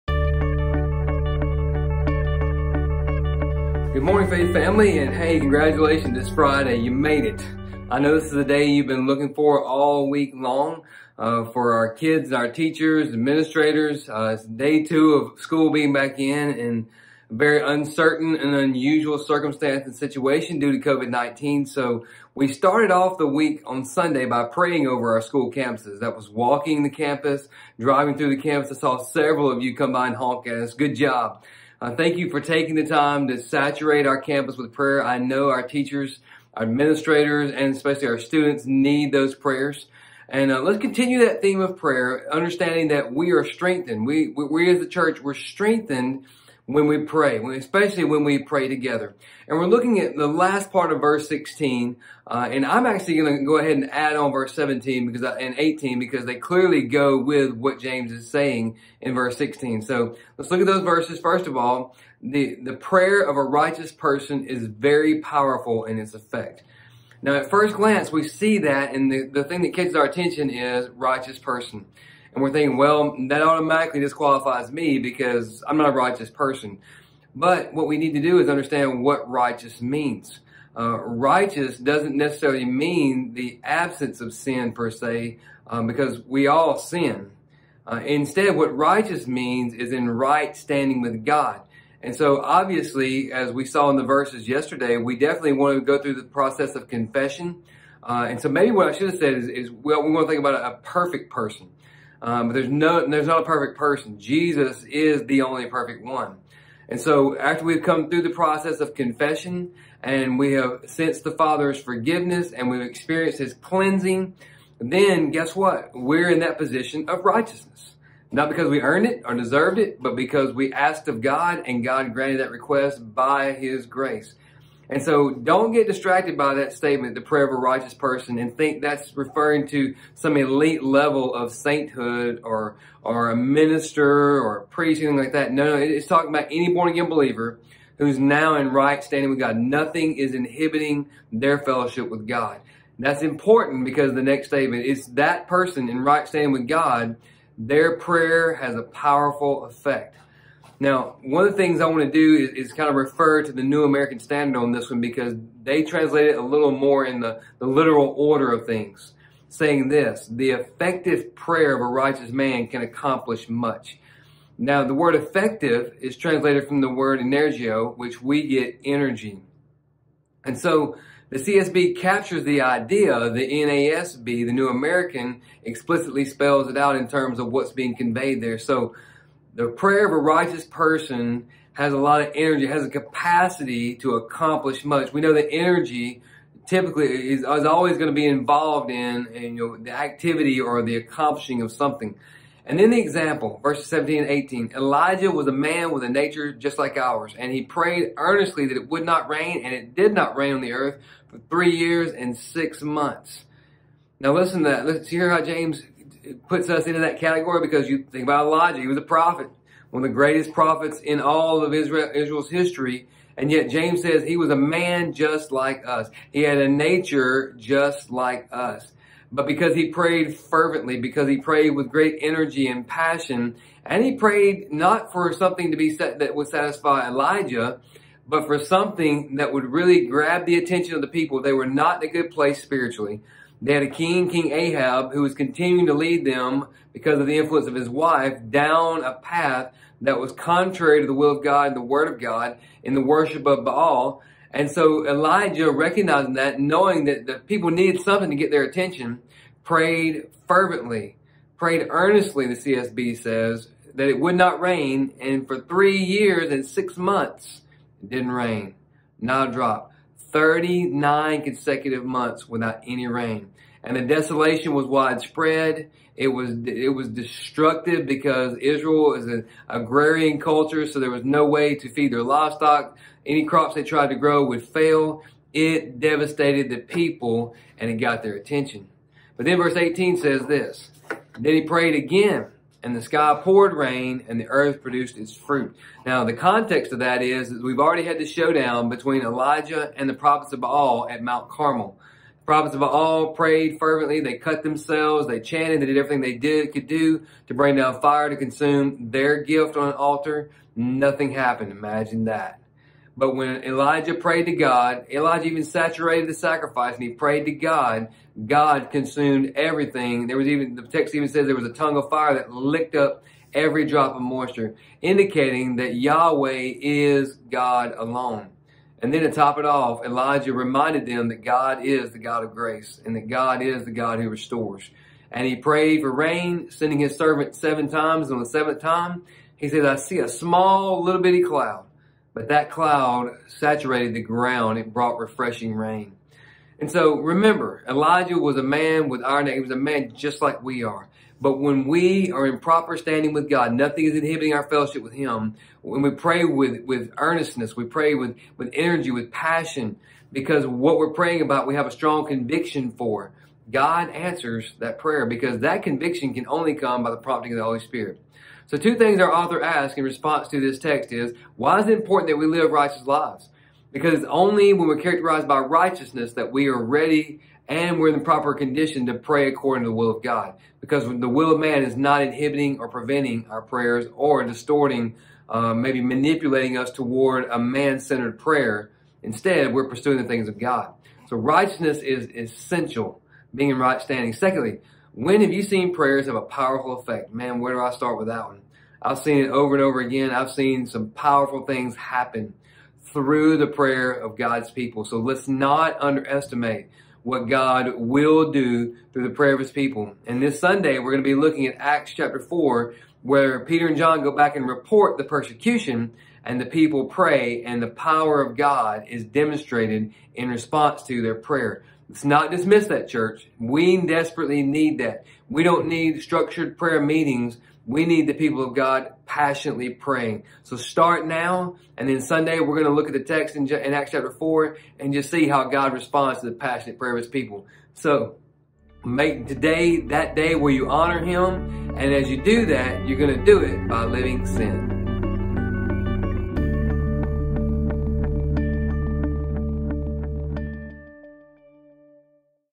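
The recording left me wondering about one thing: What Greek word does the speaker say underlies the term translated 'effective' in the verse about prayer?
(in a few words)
energio.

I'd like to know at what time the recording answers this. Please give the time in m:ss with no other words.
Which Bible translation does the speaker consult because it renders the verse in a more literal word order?
2:33.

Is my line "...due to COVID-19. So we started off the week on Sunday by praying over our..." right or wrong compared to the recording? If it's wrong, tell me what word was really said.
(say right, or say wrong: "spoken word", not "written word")
right.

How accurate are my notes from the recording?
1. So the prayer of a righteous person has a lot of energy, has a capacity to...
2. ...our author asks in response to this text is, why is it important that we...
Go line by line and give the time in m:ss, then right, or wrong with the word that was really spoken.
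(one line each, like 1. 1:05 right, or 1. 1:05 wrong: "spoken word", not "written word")
1. 2:58 right
2. 5:59 right.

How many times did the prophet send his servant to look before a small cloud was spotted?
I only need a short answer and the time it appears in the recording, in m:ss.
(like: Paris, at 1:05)
7, at 5:27.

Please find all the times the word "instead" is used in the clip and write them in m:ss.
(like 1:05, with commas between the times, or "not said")
1:28, 6:19.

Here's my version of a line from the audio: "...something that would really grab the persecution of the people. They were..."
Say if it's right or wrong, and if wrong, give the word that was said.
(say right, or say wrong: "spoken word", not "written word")
wrong: "attention", not "persecution".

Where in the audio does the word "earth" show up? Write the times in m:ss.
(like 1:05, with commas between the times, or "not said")
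3:20, 4:44.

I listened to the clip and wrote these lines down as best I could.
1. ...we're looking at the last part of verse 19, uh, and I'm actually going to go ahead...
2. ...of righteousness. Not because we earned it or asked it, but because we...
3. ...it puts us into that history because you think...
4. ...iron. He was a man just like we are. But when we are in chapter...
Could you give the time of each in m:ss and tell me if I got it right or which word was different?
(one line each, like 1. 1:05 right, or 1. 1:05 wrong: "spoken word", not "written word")
1. 0:49 wrong: "16", not "19"
2. 1:57 wrong: "deserved", not "asked"
3. 3:26 wrong: "category", not "history"
4. 5:39 wrong: "proper", not "chapter".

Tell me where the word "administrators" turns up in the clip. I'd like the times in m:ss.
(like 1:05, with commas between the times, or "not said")
0:13, 0:36.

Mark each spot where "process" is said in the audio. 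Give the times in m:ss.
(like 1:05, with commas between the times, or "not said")
1:36, 1:48.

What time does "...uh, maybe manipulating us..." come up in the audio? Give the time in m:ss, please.
6:15.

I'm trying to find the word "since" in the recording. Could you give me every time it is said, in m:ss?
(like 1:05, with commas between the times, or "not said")
not said.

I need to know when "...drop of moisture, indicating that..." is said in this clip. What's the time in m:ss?
5:13.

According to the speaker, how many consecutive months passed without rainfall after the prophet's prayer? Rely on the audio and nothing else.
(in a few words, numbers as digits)
39.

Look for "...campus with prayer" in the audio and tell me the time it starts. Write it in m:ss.
0:34.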